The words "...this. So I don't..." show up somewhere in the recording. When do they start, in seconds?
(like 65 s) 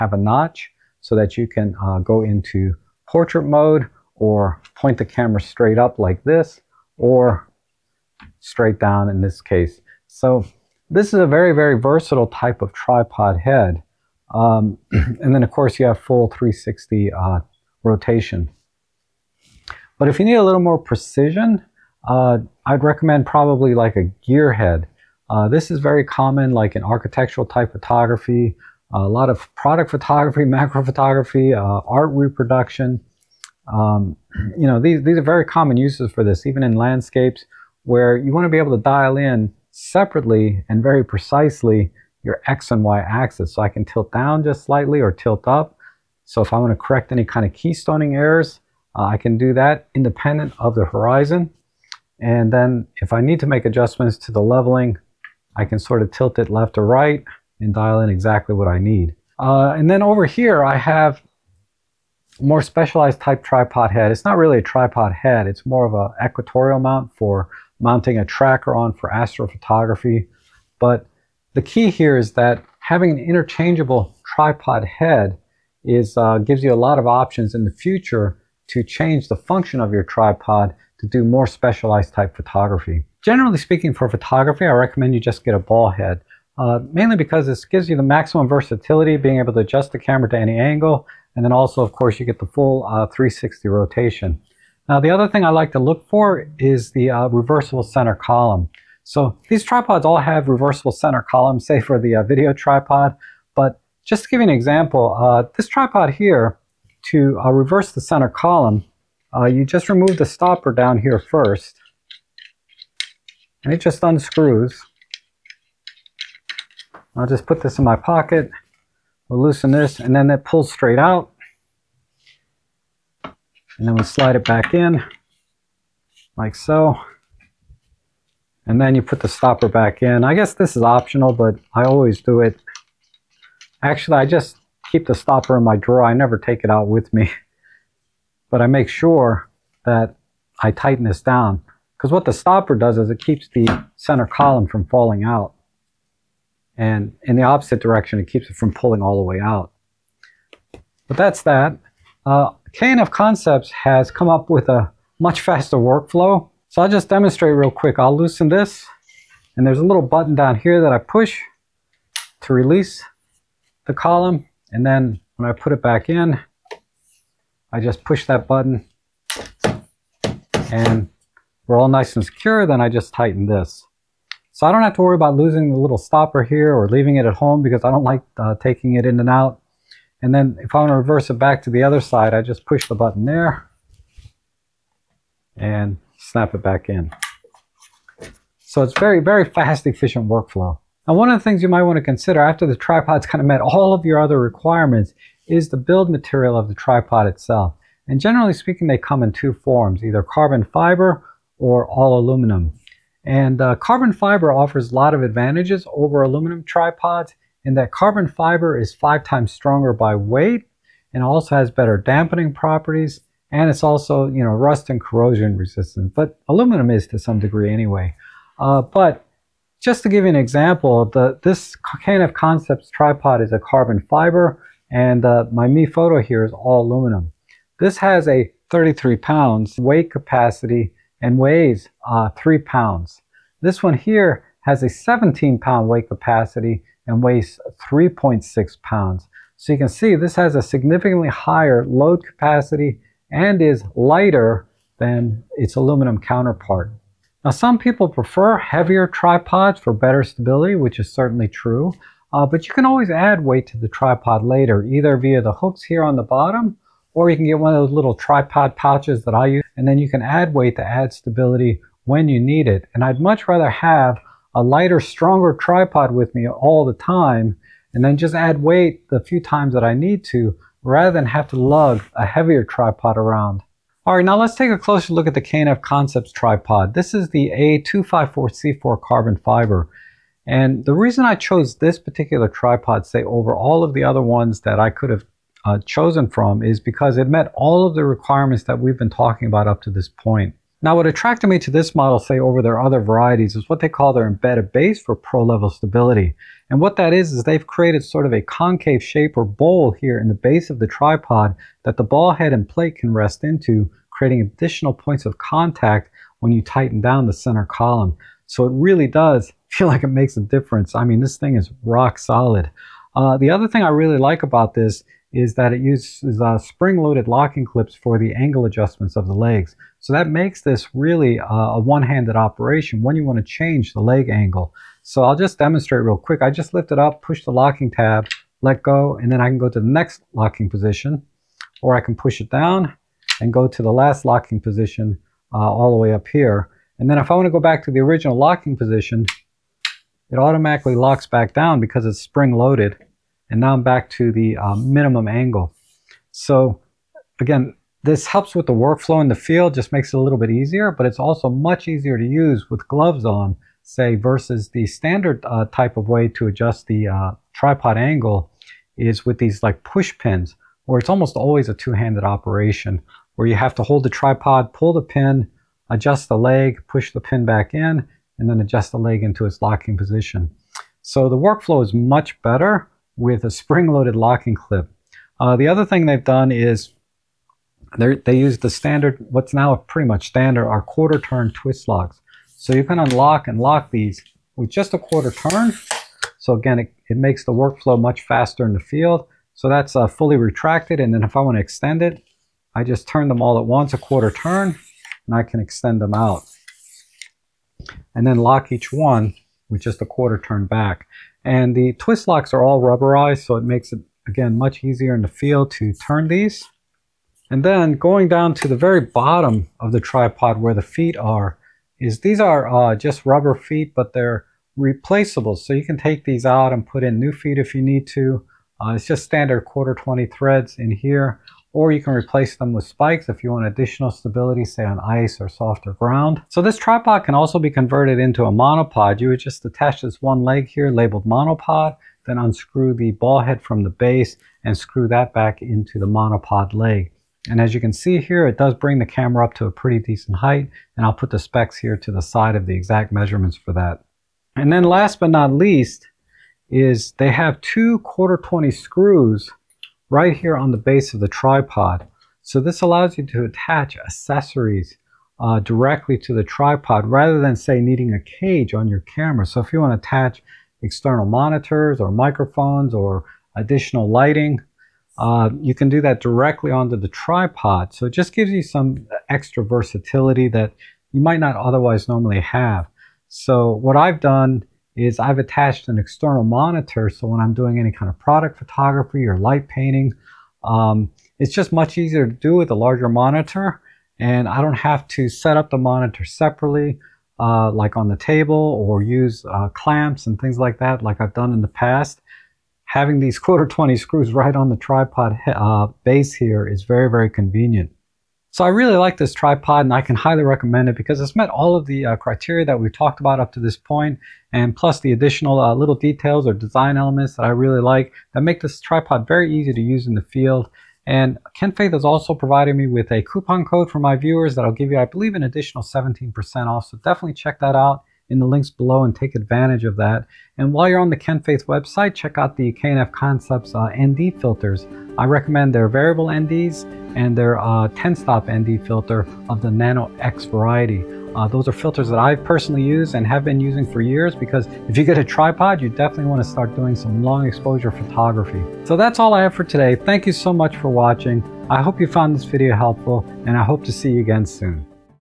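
173 s.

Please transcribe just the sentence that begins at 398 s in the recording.
And then lock each one with just a quarter turn back.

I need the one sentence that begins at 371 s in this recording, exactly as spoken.
So the workflow is much better with a spring-loaded locking clip.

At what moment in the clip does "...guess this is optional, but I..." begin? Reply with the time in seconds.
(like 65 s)
130 s.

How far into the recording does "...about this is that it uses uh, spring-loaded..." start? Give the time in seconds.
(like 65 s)
314 s.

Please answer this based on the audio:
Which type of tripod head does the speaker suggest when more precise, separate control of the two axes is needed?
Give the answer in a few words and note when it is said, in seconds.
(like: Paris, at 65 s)
gear head, at 24 s.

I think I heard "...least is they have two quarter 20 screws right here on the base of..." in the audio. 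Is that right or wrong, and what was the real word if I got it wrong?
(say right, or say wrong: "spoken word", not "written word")
right.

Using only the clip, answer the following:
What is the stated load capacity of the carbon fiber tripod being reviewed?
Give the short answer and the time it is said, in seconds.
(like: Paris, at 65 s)
33 pounds, at 228 s.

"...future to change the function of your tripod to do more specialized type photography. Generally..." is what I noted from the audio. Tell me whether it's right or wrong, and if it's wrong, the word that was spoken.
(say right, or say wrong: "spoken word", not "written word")
right.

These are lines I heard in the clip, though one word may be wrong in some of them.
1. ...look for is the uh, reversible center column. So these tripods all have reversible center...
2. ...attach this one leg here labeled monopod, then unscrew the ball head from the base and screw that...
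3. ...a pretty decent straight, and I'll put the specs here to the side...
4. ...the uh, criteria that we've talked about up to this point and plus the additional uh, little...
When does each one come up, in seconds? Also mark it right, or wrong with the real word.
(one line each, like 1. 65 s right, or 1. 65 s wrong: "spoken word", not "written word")
1. 95 s right
2. 429 s right
3. 439 s wrong: "height", not "straight"
4. 501 s right.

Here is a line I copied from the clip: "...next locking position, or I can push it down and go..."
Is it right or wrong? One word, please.
right.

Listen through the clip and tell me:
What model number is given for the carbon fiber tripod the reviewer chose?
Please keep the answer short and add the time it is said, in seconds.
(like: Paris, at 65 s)
A254C4, at 277 s.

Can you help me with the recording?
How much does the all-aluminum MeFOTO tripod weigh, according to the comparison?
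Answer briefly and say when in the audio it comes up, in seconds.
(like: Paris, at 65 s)
3.6 pounds, at 237 s.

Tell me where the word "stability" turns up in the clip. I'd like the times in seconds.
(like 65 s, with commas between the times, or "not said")
250 s, 261 s, 295 s, 424 s.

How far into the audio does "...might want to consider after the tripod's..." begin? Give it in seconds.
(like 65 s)
191 s.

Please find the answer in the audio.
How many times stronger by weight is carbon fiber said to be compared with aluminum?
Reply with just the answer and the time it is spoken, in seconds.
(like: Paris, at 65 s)
5, at 208 s.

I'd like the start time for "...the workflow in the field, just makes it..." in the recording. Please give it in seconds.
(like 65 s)
348 s.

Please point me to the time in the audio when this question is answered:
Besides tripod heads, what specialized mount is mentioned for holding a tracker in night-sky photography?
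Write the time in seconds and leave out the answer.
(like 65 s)
66 s.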